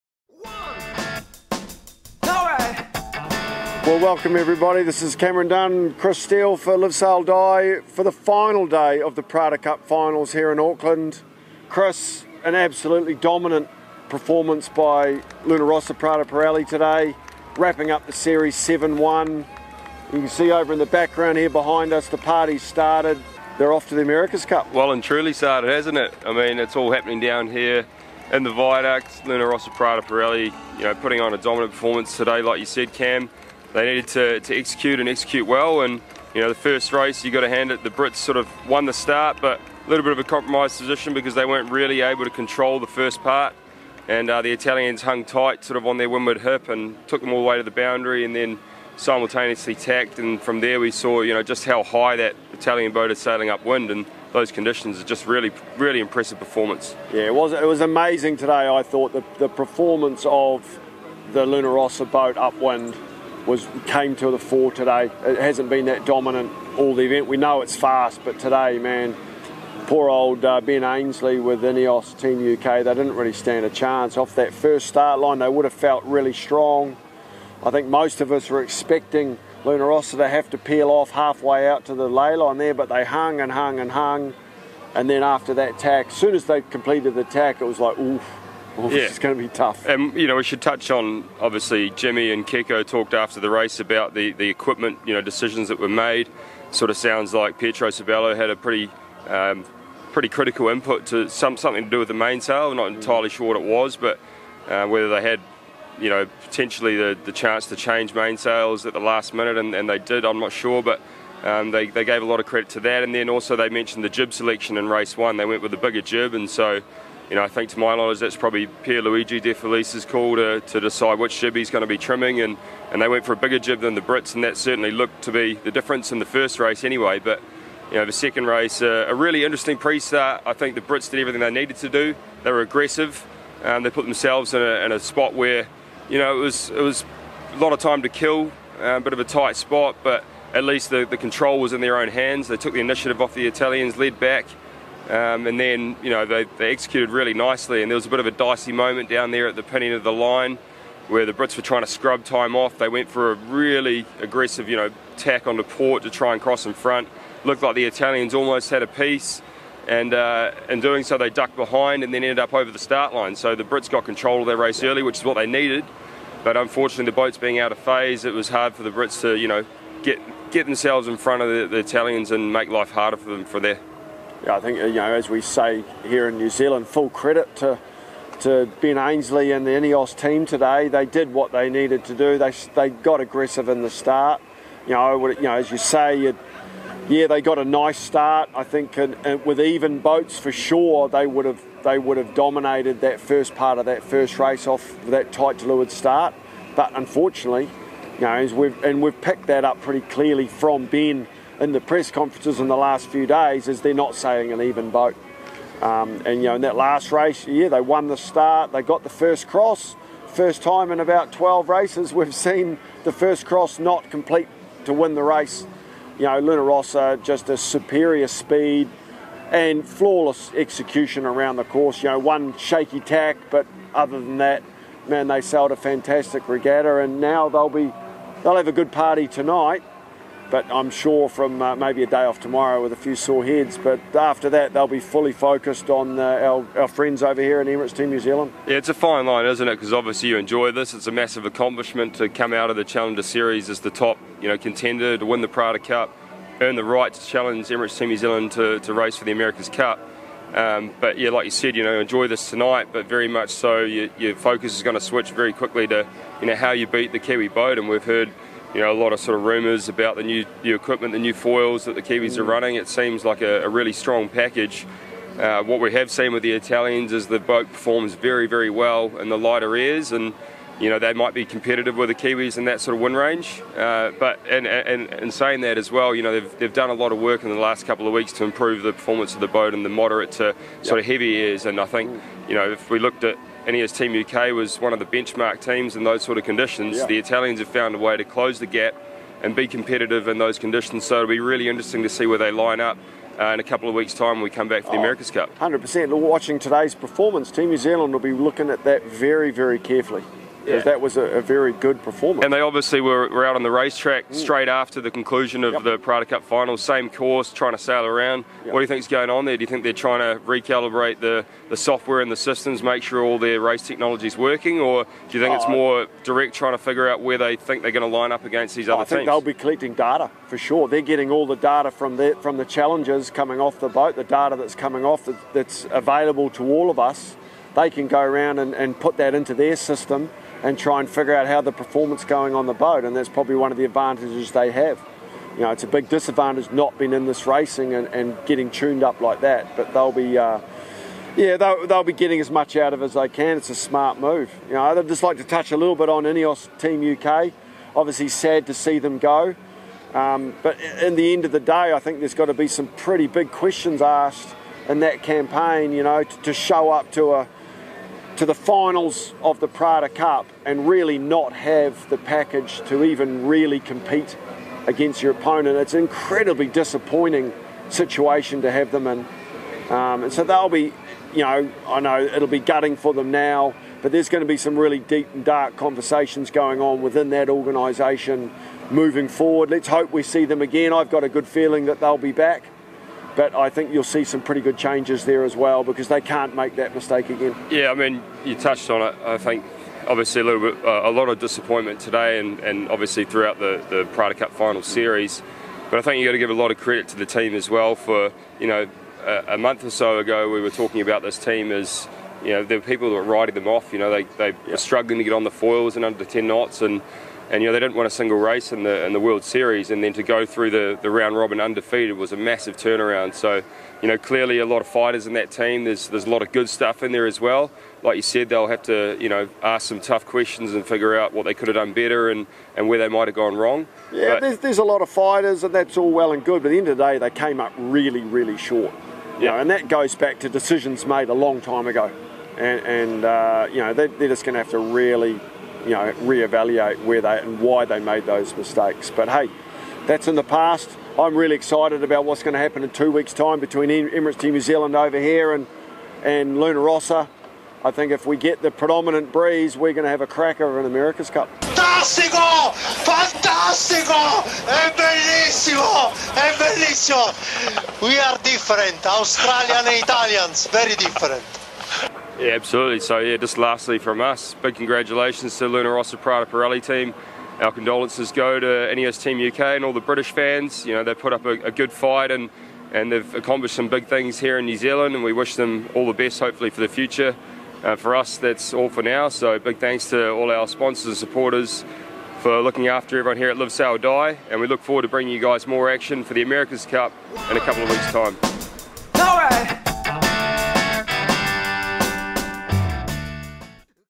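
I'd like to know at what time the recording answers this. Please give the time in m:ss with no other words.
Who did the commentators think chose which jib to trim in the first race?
1:58.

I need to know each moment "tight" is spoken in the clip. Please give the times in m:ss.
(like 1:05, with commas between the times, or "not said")
0:45, 2:19, 3:15.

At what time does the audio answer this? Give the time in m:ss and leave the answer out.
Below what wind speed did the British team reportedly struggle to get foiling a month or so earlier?
6:46.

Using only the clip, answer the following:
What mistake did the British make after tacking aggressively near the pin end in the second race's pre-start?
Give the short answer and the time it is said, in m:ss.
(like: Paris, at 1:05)
over the start line, at 2:42.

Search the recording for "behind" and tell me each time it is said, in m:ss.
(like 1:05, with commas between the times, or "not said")
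0:21, 2:41.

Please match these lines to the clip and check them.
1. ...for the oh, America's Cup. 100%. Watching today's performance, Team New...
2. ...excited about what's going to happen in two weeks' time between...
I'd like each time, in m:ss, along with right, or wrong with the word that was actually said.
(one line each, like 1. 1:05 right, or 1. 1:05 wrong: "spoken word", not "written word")
1. 4:54 right
2. 7:21 right.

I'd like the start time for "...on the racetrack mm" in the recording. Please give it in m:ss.
5:03.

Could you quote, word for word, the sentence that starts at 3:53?
But after that, they'll be fully focused on uh, our, our friends over here in Emirates Team New Zealand.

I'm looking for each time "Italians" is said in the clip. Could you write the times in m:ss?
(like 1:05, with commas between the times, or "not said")
0:44, 0:52, 2:23, 2:37, 2:51, 4:26, 4:47, 7:39.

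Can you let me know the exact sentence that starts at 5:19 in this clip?
they'll be collecting data for sure.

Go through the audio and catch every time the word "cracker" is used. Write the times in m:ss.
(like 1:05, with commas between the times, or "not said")
7:30.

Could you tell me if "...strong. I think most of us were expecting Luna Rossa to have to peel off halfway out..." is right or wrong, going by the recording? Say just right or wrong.
right.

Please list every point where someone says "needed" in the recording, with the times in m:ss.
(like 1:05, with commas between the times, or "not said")
0:33, 2:11, 2:45, 3:01.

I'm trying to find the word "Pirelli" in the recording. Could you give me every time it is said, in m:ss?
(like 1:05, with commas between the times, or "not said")
0:16, 0:30, 7:46.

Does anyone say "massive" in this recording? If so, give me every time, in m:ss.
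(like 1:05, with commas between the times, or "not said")
4:01, 6:52.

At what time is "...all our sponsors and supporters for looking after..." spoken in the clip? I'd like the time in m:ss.
8:00.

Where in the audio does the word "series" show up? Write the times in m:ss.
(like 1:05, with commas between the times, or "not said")
0:18, 4:03, 6:34, 6:49.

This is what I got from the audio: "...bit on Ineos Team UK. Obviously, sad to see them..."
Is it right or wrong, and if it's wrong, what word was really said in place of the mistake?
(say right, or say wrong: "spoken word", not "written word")
right.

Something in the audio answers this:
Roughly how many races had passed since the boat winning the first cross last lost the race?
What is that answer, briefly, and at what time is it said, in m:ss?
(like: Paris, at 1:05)
12, at 3:31.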